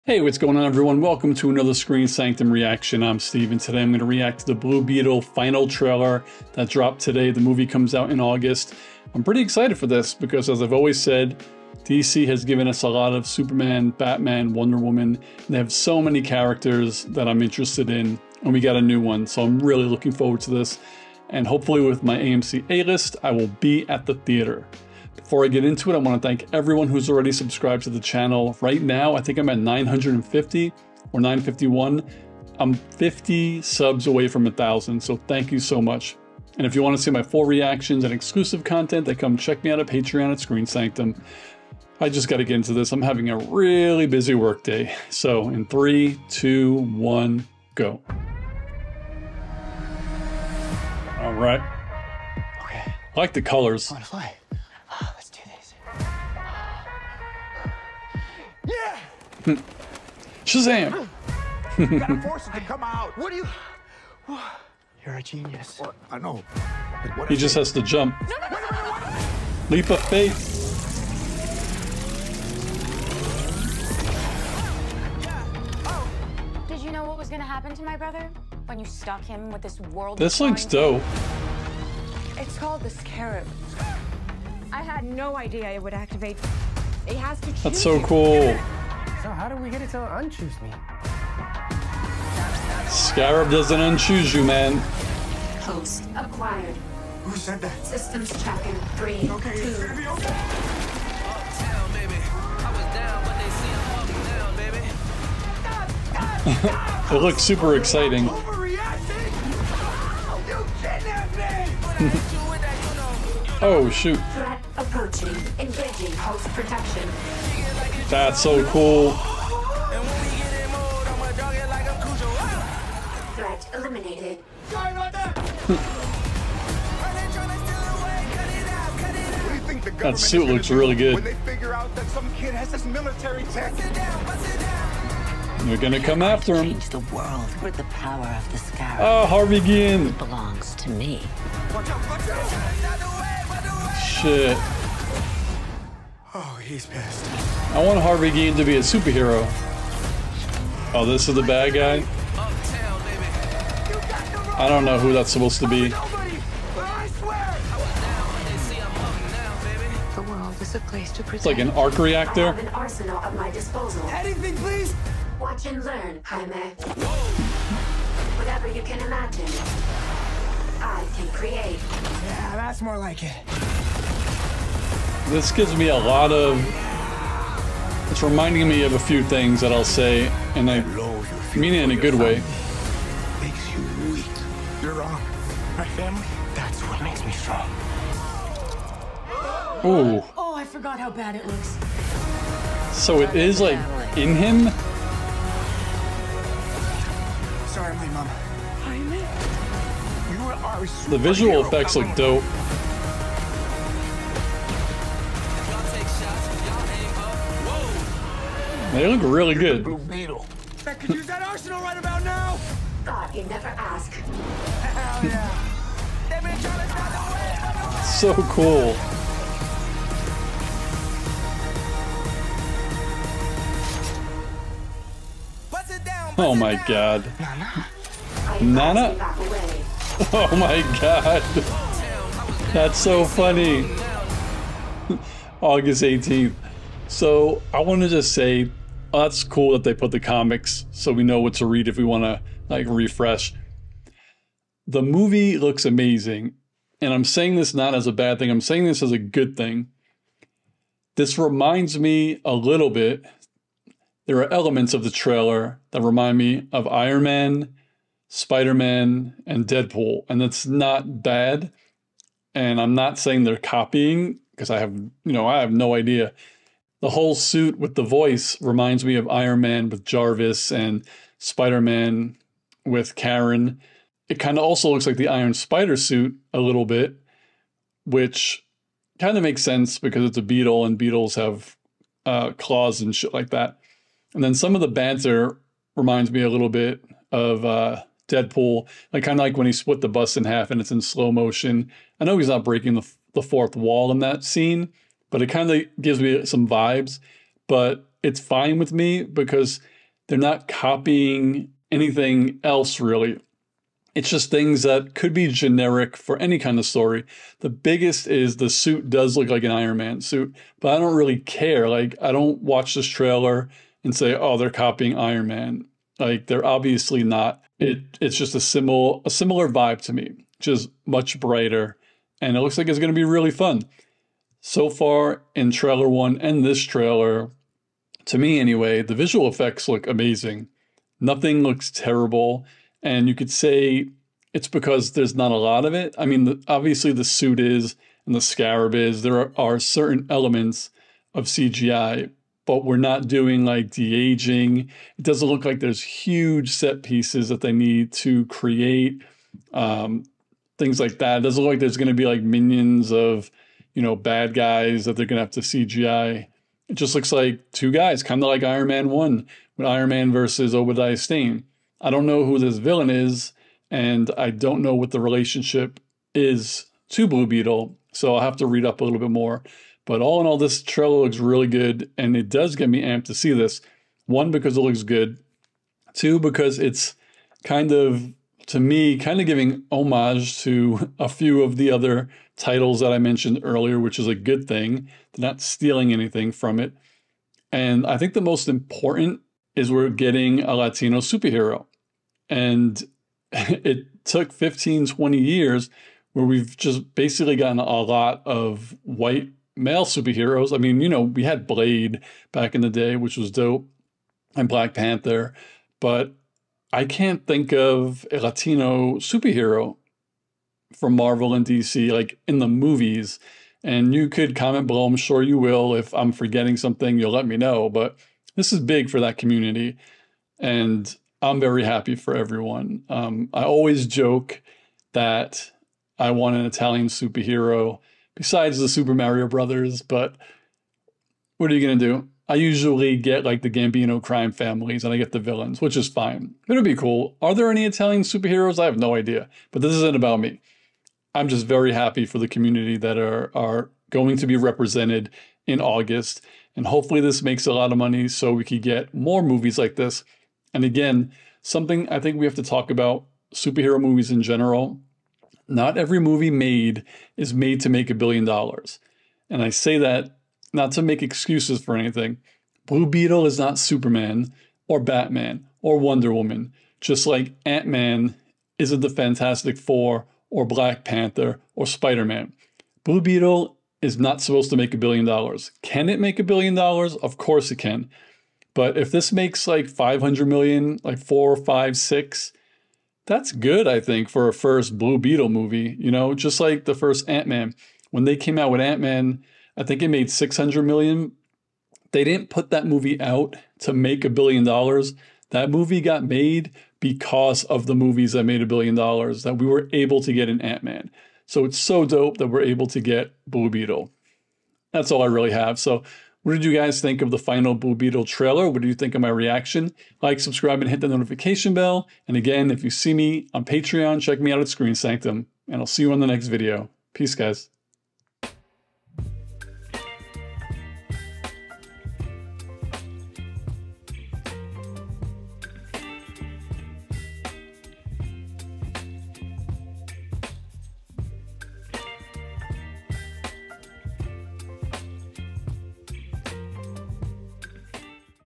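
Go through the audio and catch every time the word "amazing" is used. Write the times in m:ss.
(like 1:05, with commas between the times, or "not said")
4:05, 5:30.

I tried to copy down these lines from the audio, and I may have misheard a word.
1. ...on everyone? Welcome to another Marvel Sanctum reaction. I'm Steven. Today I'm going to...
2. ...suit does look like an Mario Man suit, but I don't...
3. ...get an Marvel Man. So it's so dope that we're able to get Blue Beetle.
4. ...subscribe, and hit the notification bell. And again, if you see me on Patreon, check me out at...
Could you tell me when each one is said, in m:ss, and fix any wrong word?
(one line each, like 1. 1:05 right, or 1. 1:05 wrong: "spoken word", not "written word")
1. 0:00 wrong: "Screen", not "Marvel"
2. 5:08 wrong: "Iron", not "Mario"
3. 8:20 wrong: "Ant", not "Marvel"
4. 8:30 right.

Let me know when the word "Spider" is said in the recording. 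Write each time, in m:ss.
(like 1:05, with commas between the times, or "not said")
4:18, 4:31, 4:35, 7:51.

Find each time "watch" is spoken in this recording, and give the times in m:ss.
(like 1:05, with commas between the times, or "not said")
2:45, 5:12.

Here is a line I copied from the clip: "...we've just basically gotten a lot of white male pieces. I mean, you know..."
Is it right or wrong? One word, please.
wrong.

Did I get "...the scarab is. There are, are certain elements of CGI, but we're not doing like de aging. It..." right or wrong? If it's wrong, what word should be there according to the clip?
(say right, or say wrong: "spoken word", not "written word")
right.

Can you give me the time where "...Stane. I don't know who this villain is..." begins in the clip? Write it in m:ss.
6:01.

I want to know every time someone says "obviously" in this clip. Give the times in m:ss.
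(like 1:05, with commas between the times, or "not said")
5:16, 5:36.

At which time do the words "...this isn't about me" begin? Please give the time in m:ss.
7:19.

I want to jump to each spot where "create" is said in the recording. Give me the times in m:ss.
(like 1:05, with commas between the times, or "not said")
2:51, 5:48.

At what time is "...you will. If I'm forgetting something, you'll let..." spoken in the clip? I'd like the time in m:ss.
6:55.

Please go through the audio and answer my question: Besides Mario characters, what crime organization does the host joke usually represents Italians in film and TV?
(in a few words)
Gambino crime families.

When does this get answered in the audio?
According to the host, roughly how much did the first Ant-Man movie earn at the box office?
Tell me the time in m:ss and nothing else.
8:10.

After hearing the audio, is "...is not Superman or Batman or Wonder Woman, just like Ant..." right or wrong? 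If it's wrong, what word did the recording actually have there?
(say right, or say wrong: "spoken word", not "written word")
right.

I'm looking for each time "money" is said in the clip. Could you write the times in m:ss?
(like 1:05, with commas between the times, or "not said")
7:27.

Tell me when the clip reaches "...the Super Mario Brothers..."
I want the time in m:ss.
7:08.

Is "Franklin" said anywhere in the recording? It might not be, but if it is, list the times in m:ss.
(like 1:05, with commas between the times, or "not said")
not said.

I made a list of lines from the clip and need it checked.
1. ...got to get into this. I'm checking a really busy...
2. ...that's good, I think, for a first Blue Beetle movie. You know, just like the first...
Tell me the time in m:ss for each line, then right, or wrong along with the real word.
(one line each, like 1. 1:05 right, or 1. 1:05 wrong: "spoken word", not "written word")
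1. 0:42 wrong: "having", not "checking"
2. 8:03 right.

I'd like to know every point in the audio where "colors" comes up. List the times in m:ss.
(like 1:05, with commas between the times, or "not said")
0:53.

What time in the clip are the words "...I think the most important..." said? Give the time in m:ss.
6:28.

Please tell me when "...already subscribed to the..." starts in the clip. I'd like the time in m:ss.
0:27.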